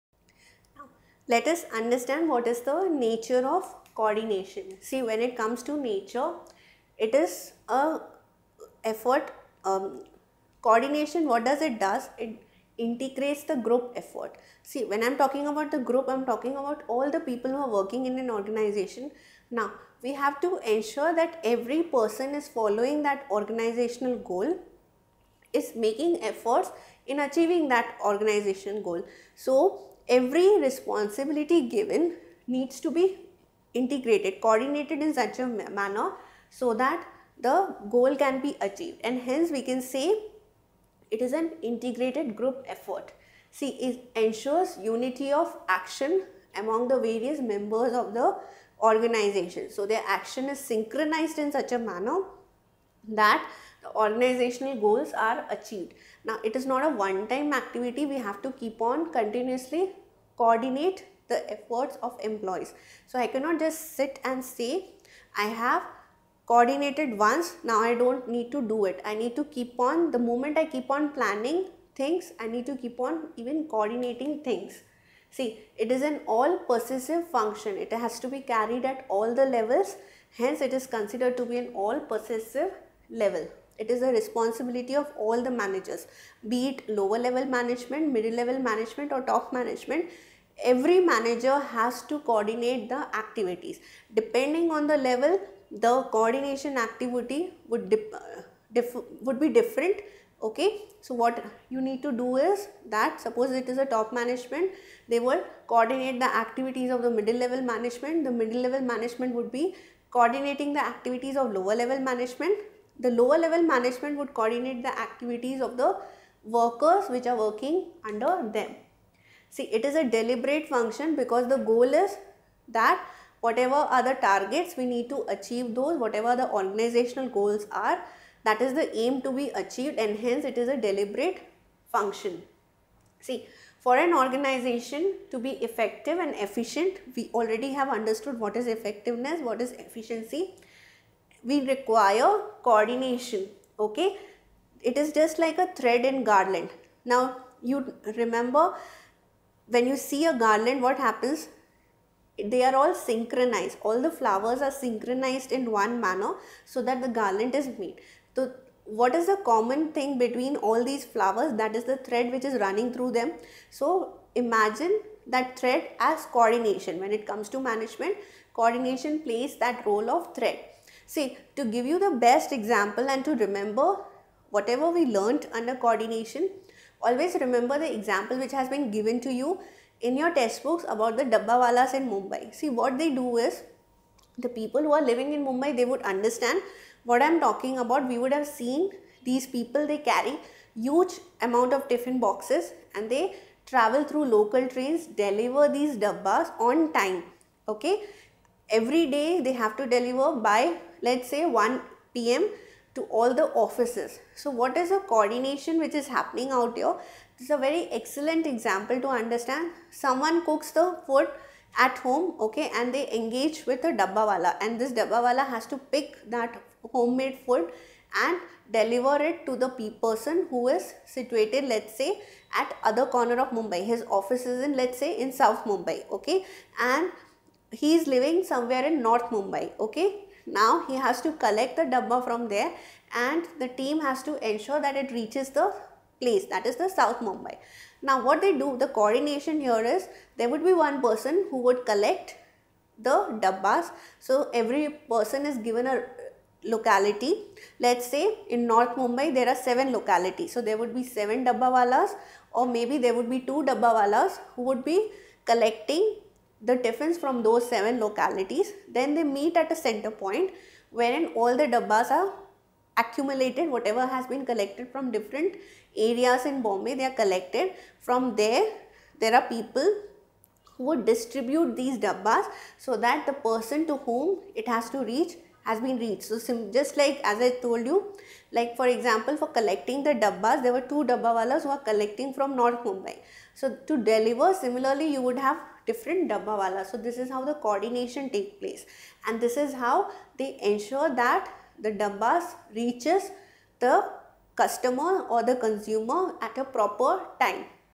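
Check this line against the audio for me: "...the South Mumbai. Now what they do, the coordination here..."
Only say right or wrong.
right.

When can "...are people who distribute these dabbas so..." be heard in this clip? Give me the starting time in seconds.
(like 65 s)
269 s.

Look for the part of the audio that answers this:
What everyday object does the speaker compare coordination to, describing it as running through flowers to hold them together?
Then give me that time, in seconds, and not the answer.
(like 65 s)
145 s.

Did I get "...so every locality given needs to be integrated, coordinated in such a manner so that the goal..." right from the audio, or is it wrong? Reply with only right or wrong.
wrong.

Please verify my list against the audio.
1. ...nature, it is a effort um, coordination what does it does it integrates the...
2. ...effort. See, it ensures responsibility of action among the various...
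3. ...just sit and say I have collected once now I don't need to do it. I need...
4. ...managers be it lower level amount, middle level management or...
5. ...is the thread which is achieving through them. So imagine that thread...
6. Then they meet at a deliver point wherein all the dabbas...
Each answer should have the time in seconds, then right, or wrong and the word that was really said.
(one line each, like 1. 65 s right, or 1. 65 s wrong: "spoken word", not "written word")
1. 5 s right
2. 42 s wrong: "unity", not "responsibility"
3. 63 s wrong: "coordinated", not "collected"
4. 85 s wrong: "management", not "amount"
5. 161 s wrong: "running", not "achieving"
6. 258 s wrong: "center", not "deliver".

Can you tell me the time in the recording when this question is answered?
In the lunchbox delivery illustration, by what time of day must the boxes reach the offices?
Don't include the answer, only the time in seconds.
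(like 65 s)
201 s.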